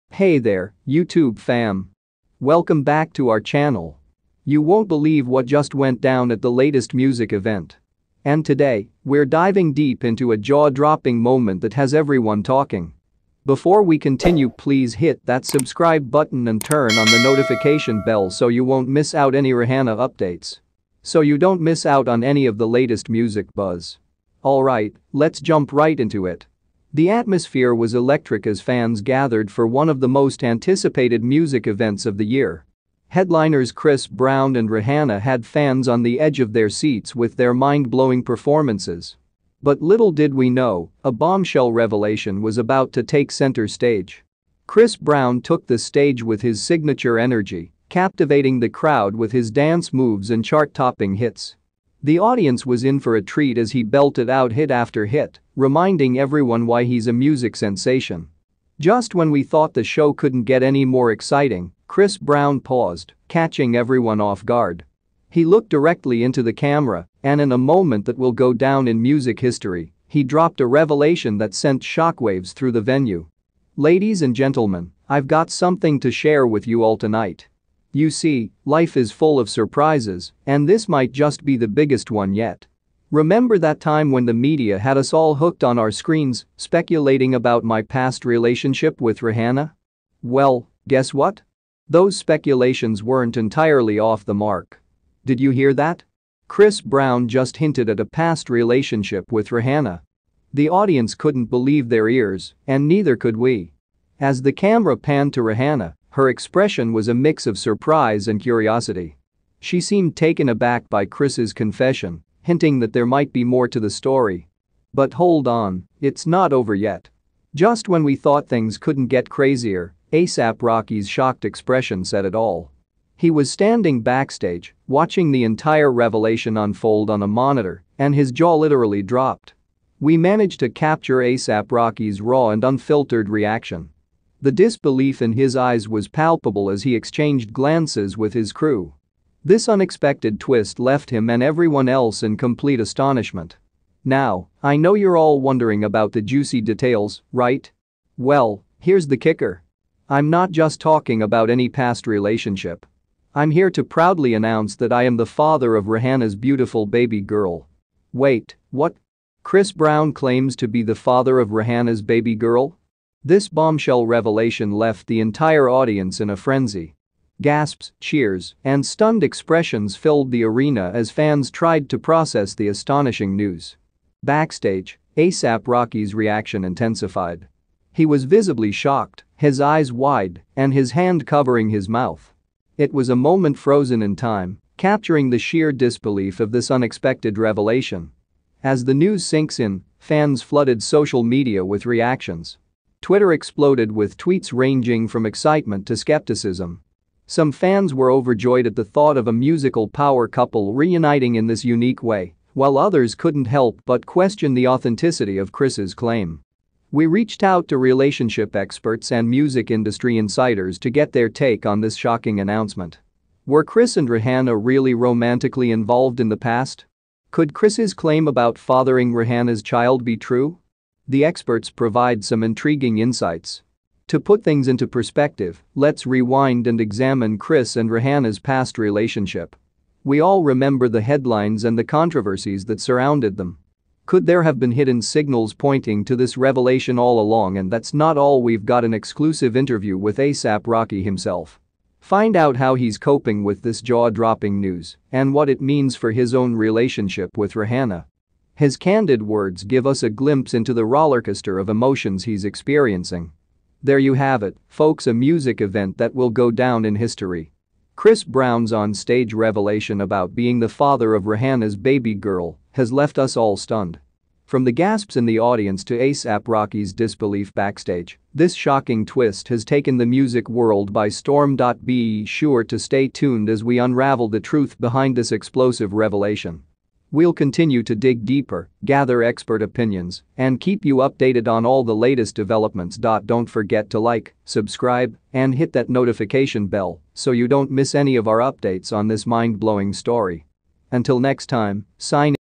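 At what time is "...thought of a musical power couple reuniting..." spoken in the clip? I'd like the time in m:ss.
3:18.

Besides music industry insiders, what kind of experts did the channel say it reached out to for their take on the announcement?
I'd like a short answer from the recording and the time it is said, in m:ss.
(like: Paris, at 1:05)
relationship experts, at 3:27.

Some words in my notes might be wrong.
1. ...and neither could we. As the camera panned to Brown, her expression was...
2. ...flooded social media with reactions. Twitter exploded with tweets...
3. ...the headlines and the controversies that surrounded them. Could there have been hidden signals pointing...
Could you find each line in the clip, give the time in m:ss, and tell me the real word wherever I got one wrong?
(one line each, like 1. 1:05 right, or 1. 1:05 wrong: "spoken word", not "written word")
1. 1:42 wrong: "Rihanna", not "Brown"
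2. 3:10 right
3. 3:50 right.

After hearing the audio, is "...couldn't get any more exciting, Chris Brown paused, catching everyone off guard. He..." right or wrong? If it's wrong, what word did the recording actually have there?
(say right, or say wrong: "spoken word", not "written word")
right.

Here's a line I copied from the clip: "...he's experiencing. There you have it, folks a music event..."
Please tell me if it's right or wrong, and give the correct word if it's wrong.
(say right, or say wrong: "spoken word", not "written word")
right.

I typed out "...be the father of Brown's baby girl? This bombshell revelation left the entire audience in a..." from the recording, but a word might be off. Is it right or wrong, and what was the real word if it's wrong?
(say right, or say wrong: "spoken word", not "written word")
wrong: "Rihanna", not "Brown".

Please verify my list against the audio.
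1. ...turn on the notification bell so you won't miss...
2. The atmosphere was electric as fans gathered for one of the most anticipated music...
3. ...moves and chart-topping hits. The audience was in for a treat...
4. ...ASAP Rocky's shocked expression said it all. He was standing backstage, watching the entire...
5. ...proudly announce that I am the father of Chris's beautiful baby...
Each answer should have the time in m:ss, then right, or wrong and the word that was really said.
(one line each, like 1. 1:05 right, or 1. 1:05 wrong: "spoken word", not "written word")
1. 0:16 right
2. 0:26 right
3. 0:49 right
4. 2:00 right
5. 2:33 wrong: "Rihanna", not "Chris".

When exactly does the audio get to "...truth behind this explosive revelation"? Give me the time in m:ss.
4:34.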